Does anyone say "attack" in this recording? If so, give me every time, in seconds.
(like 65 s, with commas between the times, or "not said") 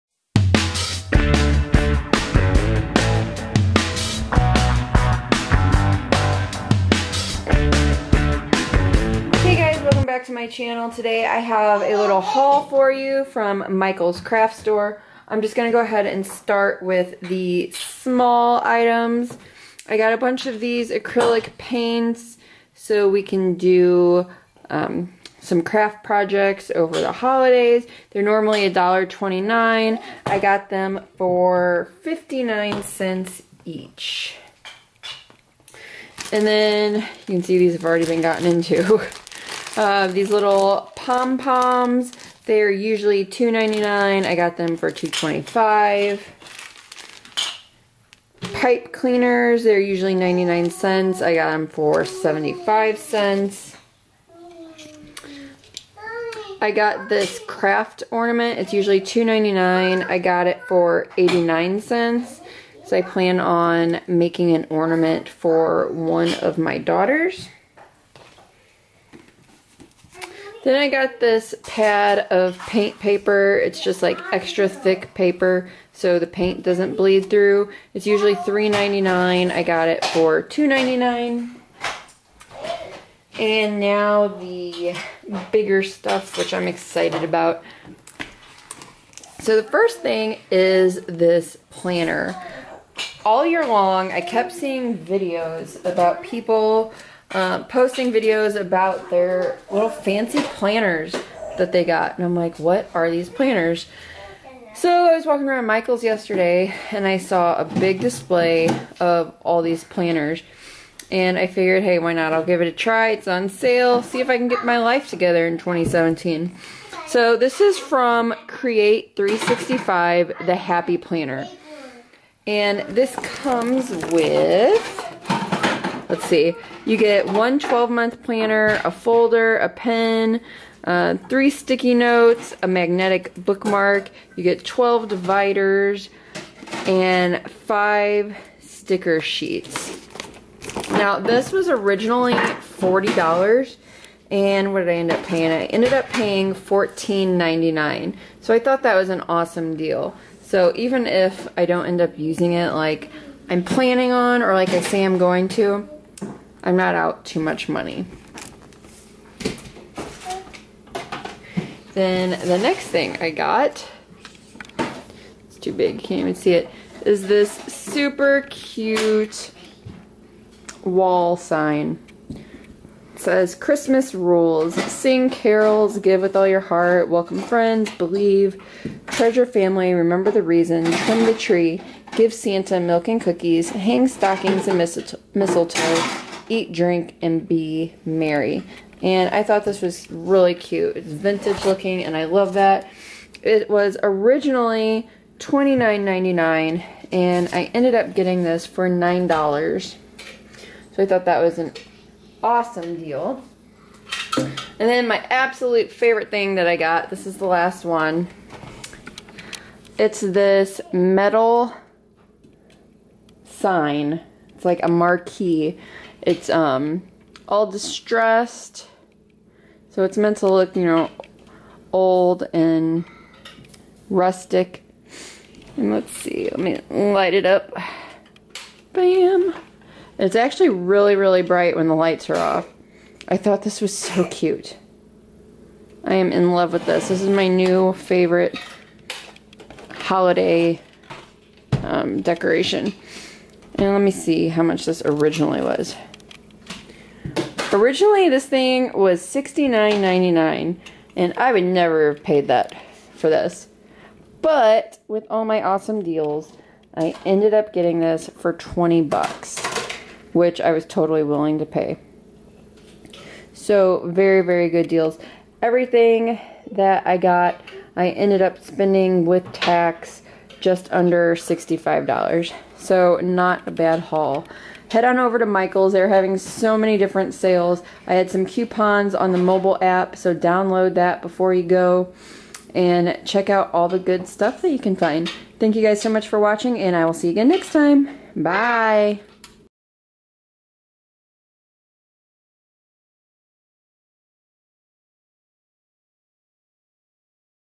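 not said.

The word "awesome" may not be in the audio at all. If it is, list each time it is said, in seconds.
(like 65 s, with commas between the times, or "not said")
149 s, 202 s, 255 s.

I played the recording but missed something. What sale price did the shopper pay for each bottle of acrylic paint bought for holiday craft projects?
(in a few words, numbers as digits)
59 cents.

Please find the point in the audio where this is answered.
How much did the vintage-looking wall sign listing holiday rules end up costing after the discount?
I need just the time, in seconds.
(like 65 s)
198 s.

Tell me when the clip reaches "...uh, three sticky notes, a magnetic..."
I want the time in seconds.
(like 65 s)
130 s.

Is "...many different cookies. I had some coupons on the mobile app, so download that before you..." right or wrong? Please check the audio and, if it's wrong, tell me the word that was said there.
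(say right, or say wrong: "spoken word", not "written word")
wrong: "sales", not "cookies".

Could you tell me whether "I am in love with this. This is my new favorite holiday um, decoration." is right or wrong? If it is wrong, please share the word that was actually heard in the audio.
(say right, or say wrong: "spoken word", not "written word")
right.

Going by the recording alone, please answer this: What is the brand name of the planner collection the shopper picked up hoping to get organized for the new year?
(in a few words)
Create 365.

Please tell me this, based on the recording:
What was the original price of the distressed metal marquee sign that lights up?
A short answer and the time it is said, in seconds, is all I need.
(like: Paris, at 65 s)
$69.99, at 249 s.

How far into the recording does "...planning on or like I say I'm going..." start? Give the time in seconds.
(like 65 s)
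153 s.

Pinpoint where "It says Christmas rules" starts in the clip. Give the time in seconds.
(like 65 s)
172 s.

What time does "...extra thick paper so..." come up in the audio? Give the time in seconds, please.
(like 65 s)
74 s.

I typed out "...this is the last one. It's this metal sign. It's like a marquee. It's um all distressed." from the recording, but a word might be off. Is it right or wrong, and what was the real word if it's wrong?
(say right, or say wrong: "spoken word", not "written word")
right.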